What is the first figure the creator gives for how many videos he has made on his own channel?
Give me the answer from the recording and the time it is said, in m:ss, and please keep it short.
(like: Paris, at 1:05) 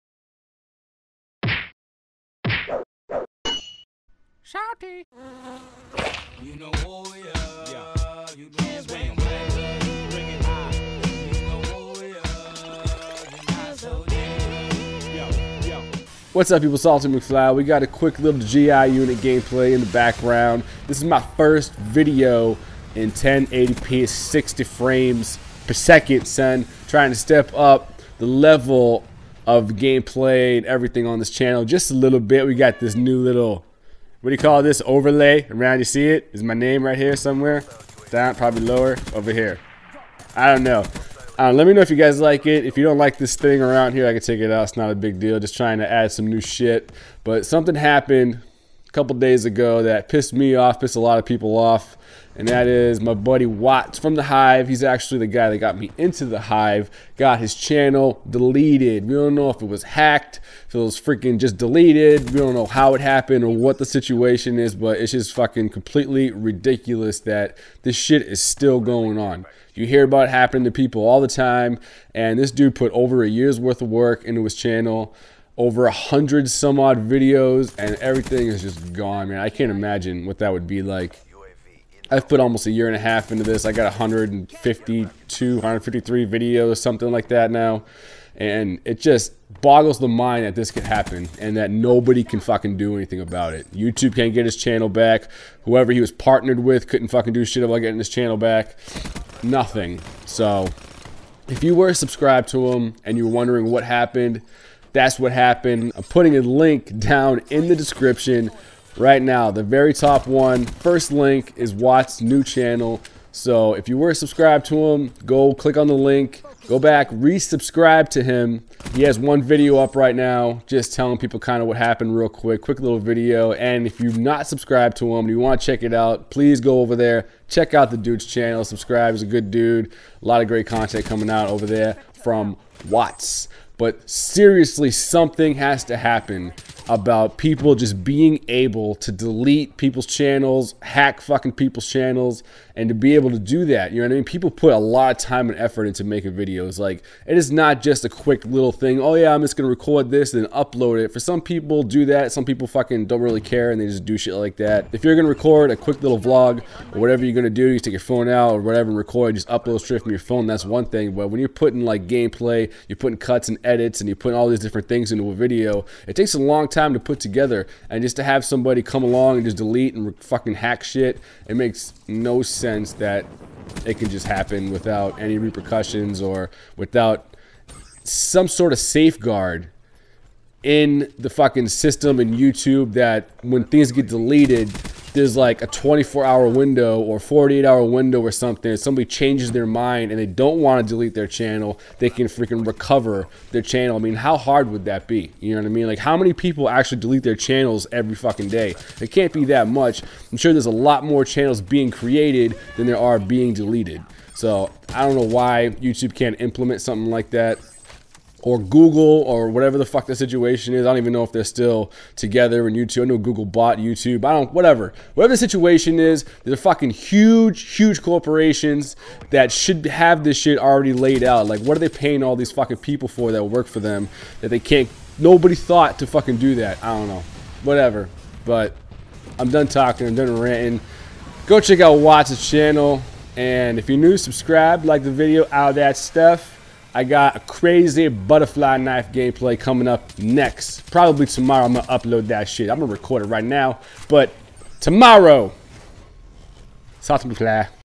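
152, at 1:23.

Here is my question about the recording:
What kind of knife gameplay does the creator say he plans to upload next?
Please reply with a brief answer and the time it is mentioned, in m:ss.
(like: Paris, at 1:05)
Butterfly knife, at 3:58.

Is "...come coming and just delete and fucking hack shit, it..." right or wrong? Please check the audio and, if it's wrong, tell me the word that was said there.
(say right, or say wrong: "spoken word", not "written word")
wrong: "along", not "coming".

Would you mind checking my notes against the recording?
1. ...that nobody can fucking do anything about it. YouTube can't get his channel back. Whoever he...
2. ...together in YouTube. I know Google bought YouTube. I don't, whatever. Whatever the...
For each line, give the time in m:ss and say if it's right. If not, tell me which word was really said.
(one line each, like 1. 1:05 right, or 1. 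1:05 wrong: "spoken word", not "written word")
1. 1:31 right
2. 3:32 right.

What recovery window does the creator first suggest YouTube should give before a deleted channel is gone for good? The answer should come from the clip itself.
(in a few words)
24 hours.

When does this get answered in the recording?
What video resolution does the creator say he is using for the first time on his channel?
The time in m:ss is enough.
0:23.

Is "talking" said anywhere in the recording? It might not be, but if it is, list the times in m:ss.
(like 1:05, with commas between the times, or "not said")
3:49.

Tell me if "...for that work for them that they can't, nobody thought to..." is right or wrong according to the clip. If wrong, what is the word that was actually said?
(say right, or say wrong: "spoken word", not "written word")
right.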